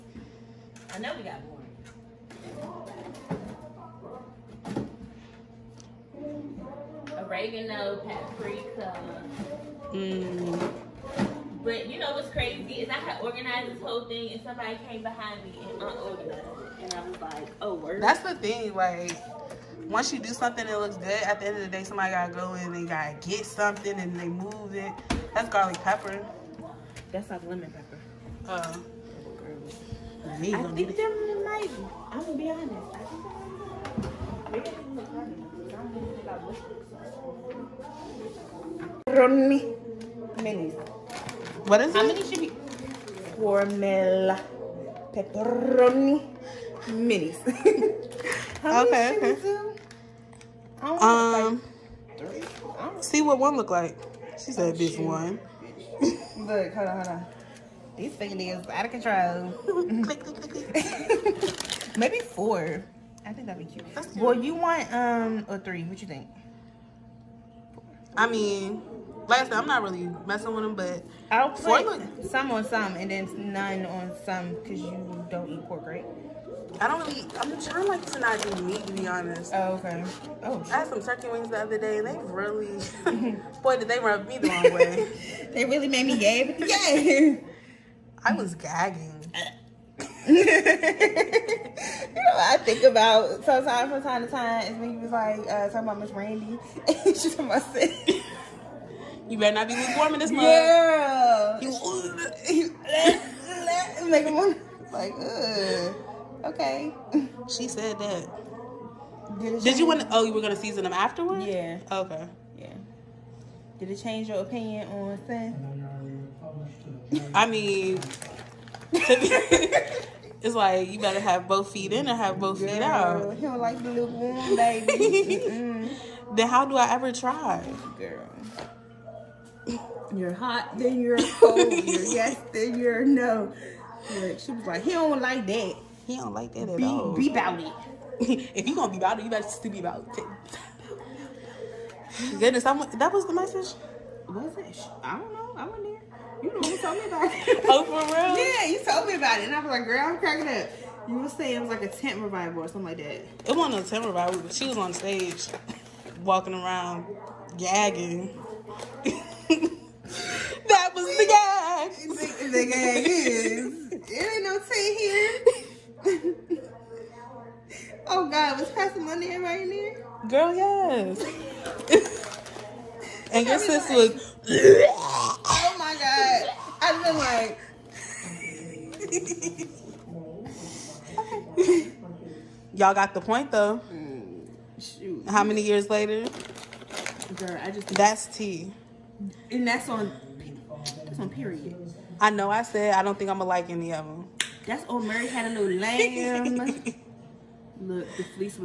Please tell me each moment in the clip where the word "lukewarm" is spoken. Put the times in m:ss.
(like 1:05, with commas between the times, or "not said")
1:39, 2:03.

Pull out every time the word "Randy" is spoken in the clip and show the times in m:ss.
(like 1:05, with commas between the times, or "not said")
1:36.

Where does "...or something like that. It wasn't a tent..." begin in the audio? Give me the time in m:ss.
2:32.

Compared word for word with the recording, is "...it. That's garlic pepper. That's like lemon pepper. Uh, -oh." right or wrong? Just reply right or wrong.
right.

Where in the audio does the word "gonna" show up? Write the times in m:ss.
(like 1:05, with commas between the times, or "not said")
0:32, 1:50, 2:18, 3:13.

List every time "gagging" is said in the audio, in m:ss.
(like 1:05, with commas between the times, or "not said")
1:28, 2:37.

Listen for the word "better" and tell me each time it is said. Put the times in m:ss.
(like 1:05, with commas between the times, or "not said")
1:39, 2:00, 2:19.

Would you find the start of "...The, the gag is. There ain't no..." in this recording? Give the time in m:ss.
2:42.